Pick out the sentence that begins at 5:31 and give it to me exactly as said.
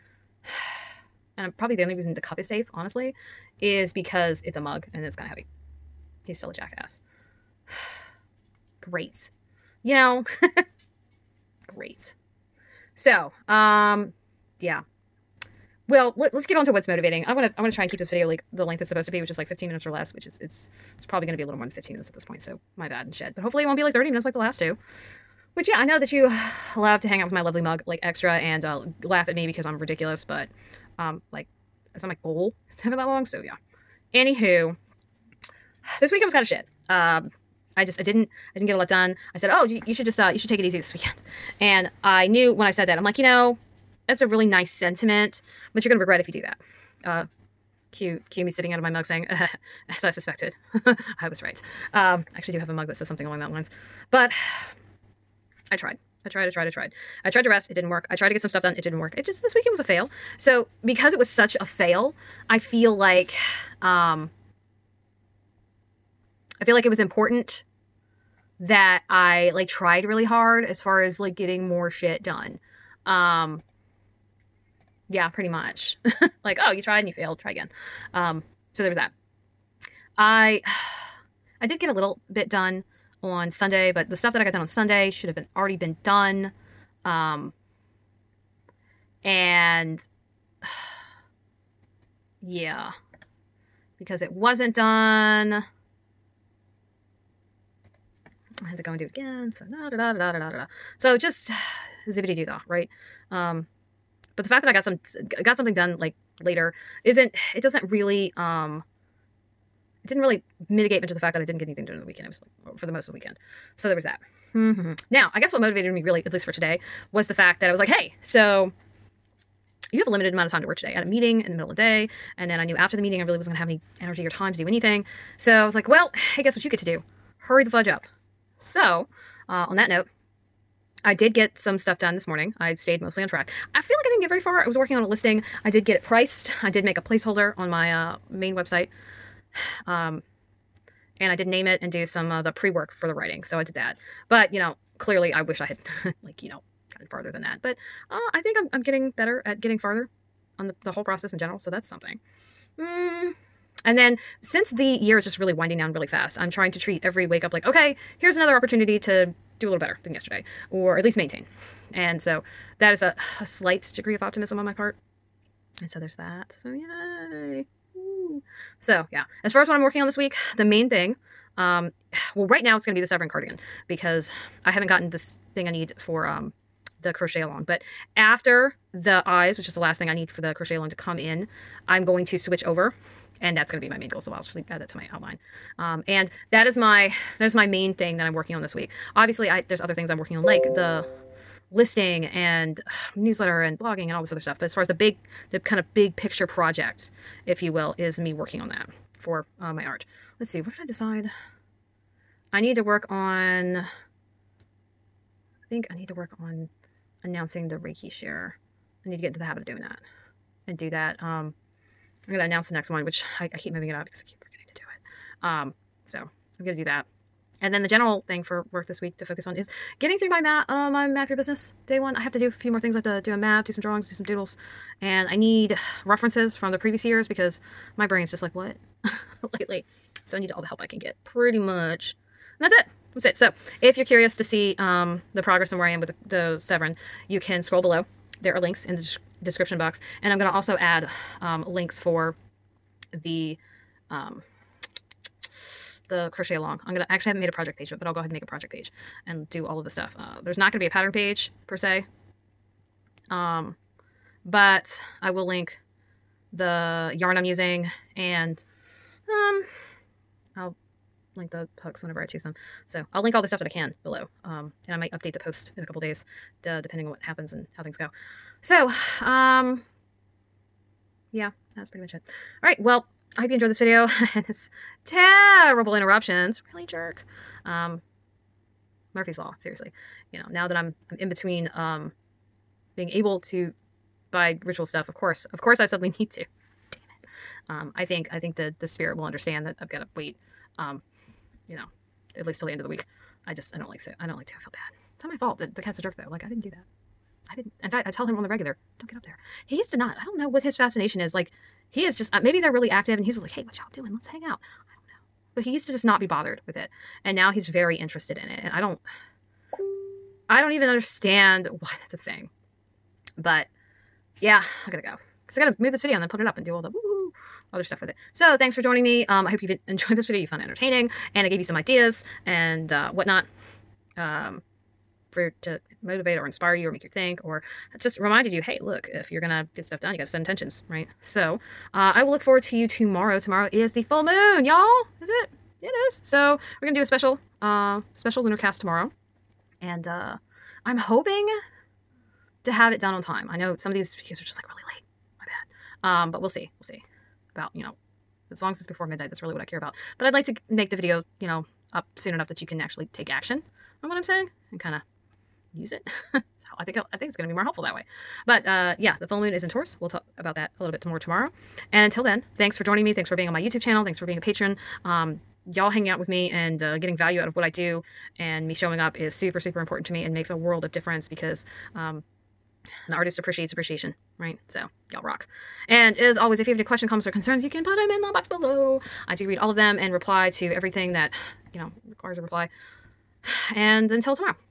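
So uh, I will look forward to you tomorrow.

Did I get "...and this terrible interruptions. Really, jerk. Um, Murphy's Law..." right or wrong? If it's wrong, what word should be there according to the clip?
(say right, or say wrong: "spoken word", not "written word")
right.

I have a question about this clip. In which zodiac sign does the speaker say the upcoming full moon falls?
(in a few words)
Taurus.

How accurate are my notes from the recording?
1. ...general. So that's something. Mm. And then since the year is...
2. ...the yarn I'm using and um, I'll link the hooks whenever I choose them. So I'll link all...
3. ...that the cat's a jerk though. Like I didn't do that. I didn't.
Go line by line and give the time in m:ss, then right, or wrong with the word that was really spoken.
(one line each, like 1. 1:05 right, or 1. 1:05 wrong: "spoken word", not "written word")
1. 2:31 right
2. 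4:16 right
3. 4:55 right.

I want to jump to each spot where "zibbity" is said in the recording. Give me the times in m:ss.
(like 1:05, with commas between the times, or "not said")
1:42.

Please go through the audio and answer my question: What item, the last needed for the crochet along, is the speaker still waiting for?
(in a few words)
the eyes.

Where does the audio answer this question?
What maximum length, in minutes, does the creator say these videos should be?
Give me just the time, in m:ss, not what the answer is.
0:19.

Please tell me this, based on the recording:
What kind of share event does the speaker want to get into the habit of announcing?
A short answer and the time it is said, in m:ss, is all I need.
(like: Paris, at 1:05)
Reiki share, at 3:27.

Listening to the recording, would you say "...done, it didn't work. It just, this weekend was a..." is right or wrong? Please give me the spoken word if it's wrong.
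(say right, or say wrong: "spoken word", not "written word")
right.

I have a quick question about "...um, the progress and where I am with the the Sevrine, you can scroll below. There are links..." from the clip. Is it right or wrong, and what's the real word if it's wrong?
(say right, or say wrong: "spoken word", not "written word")
right.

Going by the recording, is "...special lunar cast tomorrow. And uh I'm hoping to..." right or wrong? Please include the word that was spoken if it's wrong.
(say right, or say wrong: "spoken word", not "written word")
right.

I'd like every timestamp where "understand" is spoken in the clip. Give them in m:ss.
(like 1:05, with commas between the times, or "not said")
4:49, 5:10.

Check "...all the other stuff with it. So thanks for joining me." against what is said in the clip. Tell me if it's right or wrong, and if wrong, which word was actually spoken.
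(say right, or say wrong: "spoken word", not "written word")
right.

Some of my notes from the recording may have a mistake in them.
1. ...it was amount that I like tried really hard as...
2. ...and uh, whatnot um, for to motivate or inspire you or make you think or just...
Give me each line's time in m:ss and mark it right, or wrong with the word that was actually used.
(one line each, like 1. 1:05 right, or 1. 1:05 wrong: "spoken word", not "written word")
1. 1:06 wrong: "important", not "amount"
2. 5:22 right.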